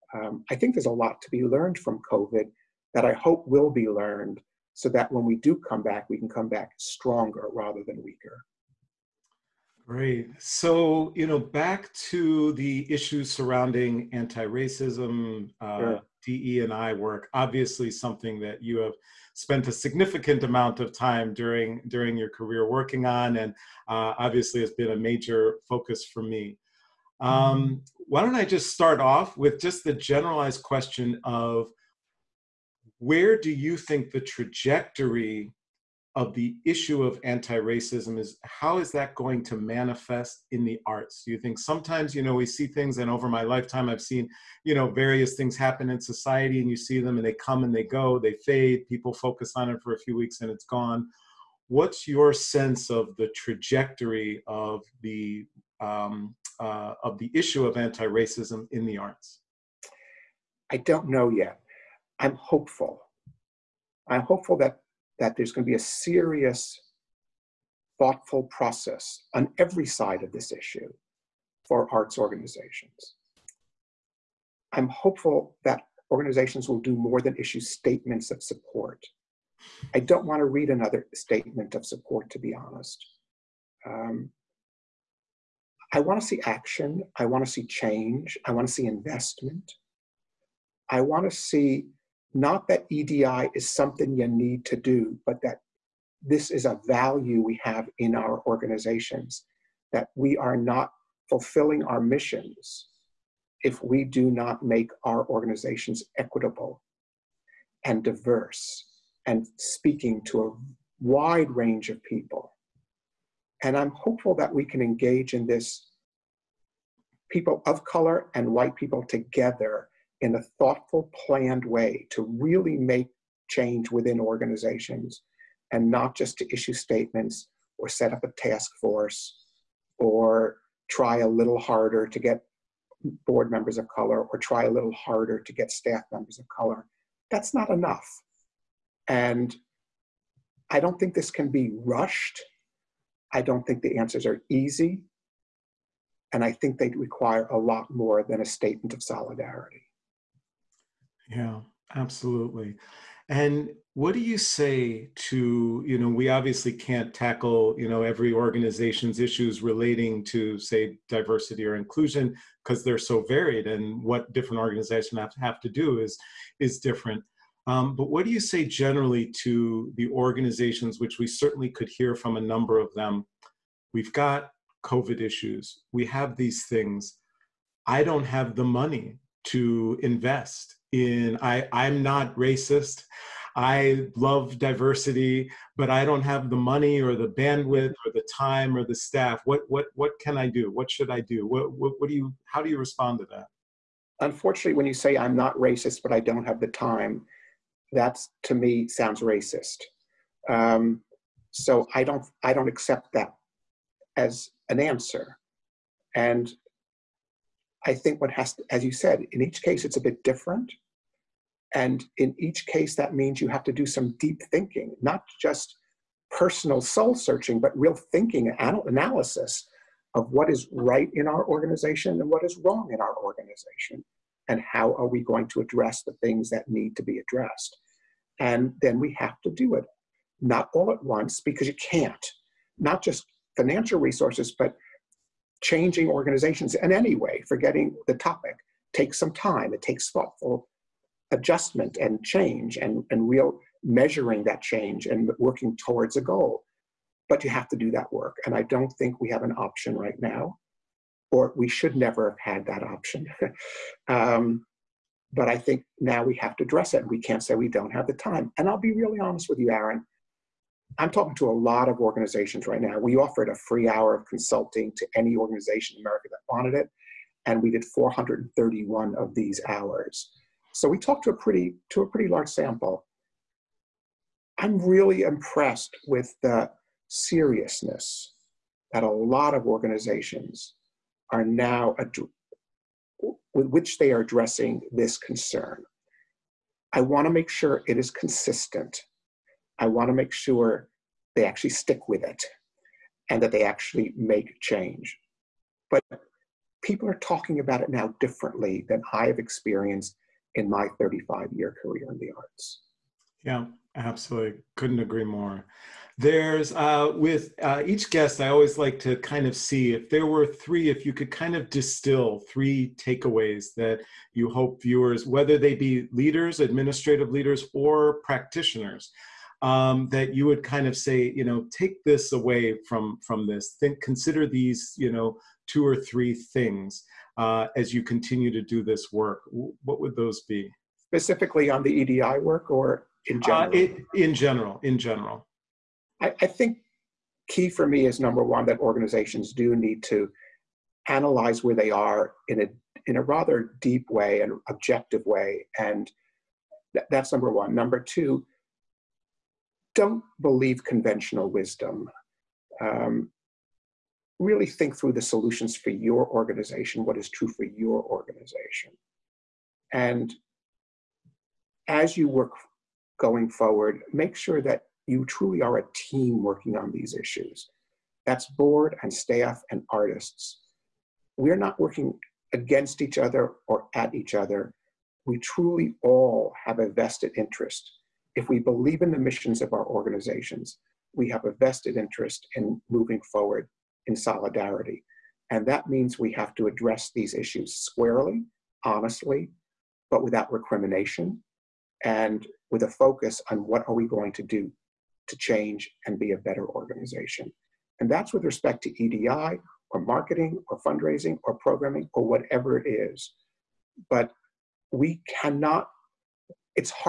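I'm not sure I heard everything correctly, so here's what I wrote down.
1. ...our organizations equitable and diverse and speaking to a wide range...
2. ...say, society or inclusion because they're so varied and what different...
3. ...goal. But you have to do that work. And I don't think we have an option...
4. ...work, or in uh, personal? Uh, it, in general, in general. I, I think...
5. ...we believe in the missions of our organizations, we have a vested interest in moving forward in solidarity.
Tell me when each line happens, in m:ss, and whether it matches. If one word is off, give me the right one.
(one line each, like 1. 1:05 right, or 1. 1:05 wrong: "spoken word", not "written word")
1. 1:45 right
2. 2:40 wrong: "diversity", not "society"
3. 4:06 right
4. 5:32 wrong: "general", not "personal"
5. 6:18 right.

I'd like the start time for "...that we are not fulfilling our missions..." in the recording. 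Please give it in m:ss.
1:39.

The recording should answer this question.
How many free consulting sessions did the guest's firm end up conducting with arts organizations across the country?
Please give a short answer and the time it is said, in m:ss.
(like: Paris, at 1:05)
431, at 4:27.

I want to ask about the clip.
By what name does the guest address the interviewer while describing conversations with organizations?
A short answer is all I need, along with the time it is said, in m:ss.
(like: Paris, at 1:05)
Aaron, at 4:19.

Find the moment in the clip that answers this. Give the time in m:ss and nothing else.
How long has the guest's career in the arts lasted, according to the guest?
5:00.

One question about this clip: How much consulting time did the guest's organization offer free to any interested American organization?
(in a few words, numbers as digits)
1 hour.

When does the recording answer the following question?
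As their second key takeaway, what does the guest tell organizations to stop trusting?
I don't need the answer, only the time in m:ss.
5:50.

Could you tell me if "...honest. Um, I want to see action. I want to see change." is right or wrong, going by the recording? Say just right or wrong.
right.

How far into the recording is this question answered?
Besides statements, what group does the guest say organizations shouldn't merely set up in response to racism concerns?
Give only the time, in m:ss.
2:08.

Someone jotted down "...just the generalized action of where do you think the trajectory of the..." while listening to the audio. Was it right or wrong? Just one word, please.
wrong.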